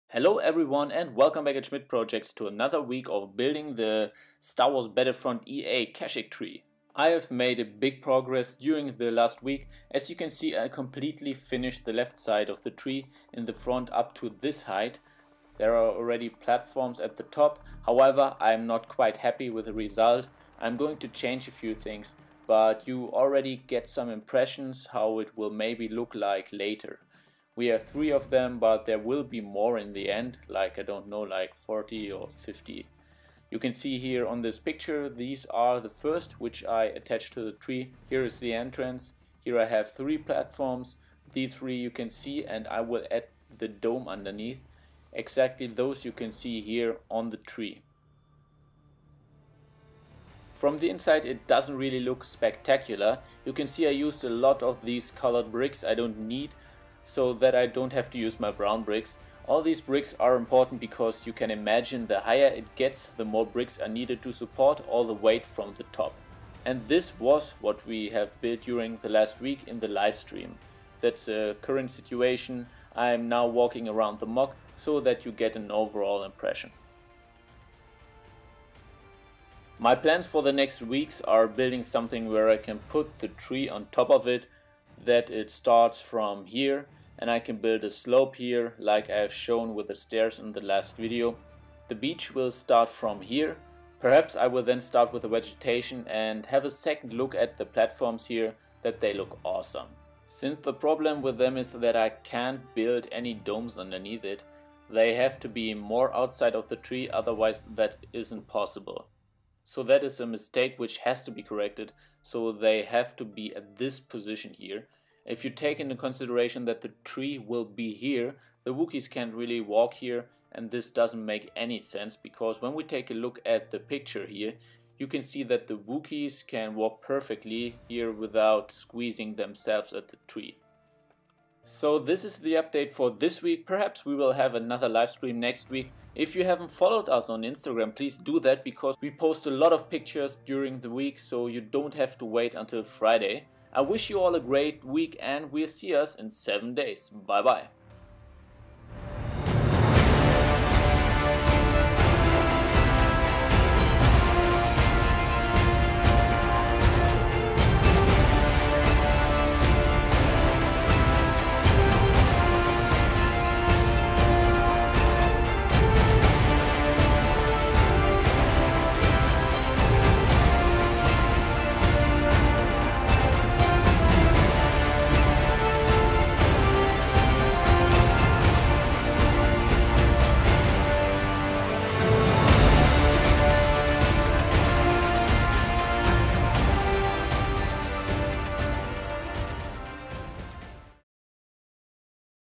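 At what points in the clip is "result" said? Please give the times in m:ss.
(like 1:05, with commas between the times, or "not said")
0:19.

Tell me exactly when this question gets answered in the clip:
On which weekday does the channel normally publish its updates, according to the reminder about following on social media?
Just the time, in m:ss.
2:22.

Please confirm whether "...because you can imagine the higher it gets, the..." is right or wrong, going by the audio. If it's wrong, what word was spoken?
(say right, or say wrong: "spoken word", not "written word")
right.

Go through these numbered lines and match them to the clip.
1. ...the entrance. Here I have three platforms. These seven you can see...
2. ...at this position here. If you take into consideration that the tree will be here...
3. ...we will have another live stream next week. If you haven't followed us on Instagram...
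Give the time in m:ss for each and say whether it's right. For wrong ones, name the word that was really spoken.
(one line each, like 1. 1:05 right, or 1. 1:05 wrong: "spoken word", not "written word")
1. 0:38 wrong: "three", not "seven"
2. 1:53 right
3. 2:14 right.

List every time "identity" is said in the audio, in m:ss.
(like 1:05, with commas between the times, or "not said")
not said.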